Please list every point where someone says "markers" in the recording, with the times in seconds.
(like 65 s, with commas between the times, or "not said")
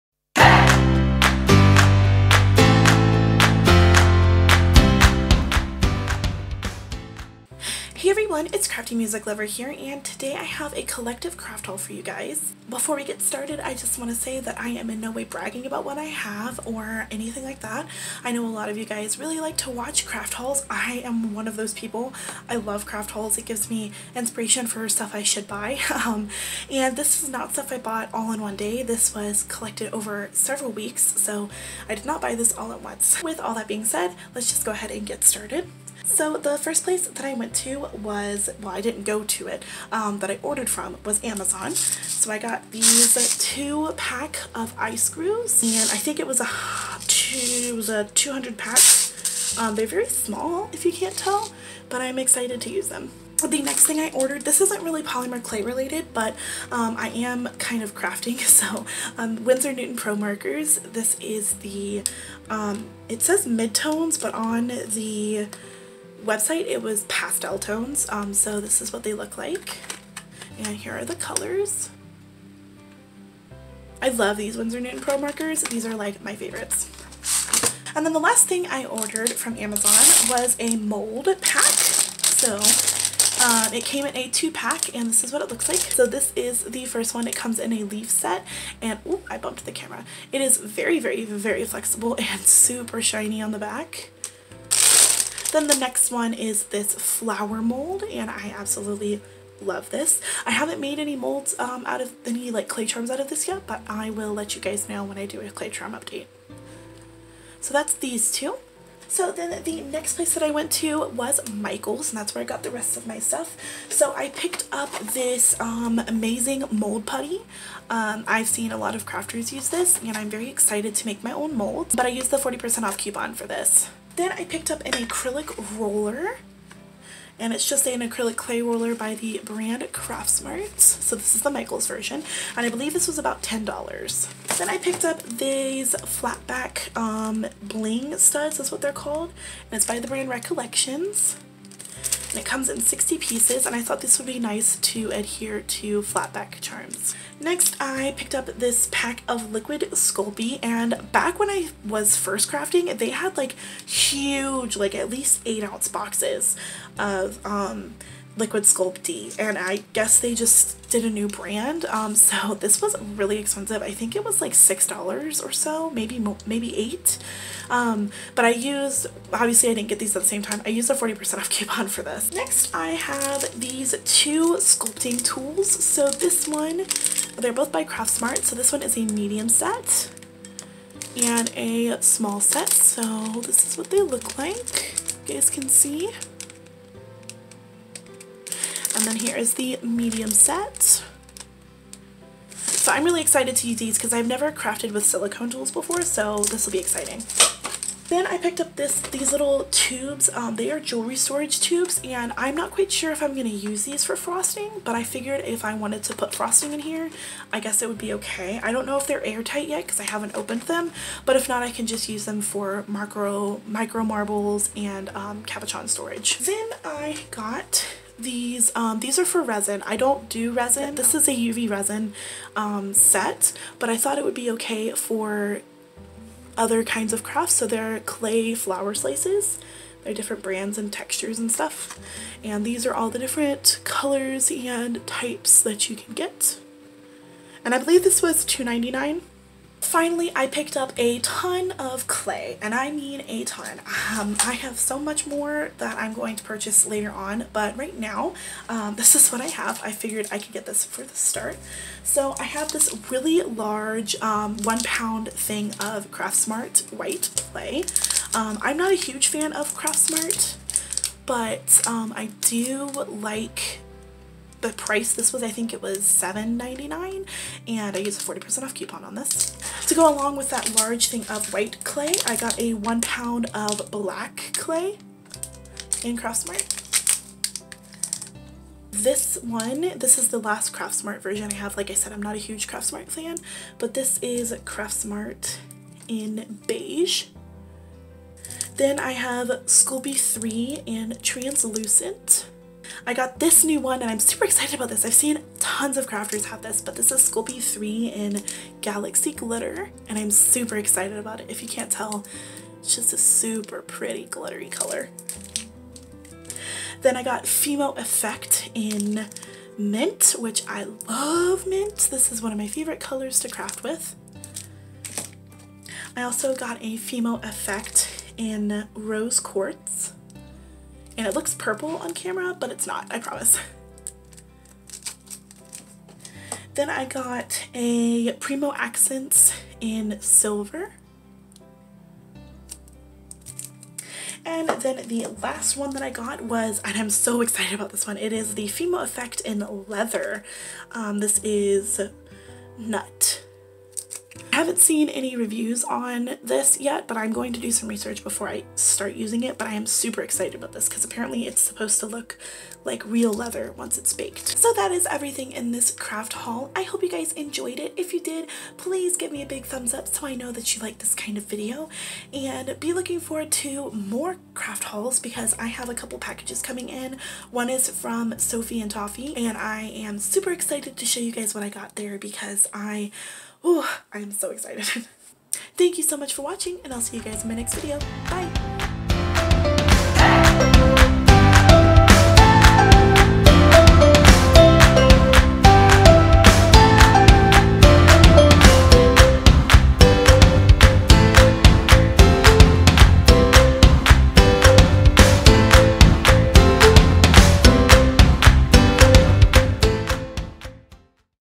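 60 s, 75 s.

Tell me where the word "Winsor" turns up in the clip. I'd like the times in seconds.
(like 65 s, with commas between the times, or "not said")
59 s, 74 s.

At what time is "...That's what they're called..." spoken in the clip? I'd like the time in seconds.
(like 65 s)
138 s.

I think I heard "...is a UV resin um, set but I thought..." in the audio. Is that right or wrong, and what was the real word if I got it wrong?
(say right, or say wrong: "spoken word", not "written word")
right.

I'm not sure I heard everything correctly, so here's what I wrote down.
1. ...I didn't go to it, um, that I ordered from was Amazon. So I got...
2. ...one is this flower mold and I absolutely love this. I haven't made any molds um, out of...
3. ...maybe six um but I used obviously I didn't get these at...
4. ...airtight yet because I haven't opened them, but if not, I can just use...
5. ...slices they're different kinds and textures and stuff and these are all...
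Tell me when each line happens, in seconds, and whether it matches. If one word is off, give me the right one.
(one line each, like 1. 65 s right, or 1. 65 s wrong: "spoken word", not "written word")
1. 38 s right
2. 96 s right
3. 166 s wrong: "eight", not "six"
4. 209 s right
5. 228 s wrong: "brands", not "kinds".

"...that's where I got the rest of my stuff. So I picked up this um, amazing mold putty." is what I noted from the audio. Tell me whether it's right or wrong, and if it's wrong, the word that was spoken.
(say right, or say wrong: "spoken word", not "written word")
right.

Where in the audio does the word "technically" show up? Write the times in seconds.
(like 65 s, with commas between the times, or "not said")
not said.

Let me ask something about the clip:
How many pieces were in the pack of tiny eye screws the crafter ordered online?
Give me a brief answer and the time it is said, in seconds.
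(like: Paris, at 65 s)
200, at 48 s.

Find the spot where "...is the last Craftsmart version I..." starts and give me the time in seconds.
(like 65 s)
280 s.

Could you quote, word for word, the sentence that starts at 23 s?
It gives me inspiration for stuff I should buy.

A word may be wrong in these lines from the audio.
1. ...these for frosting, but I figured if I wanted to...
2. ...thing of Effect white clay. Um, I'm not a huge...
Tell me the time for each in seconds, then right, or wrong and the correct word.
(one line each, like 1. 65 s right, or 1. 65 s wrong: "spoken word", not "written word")
1. 203 s right
2. 255 s wrong: "Craftsmart", not "Effect".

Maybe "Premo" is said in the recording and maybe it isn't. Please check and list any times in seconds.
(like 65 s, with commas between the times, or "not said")
328 s.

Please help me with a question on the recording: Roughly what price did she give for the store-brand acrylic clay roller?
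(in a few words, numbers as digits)
$10.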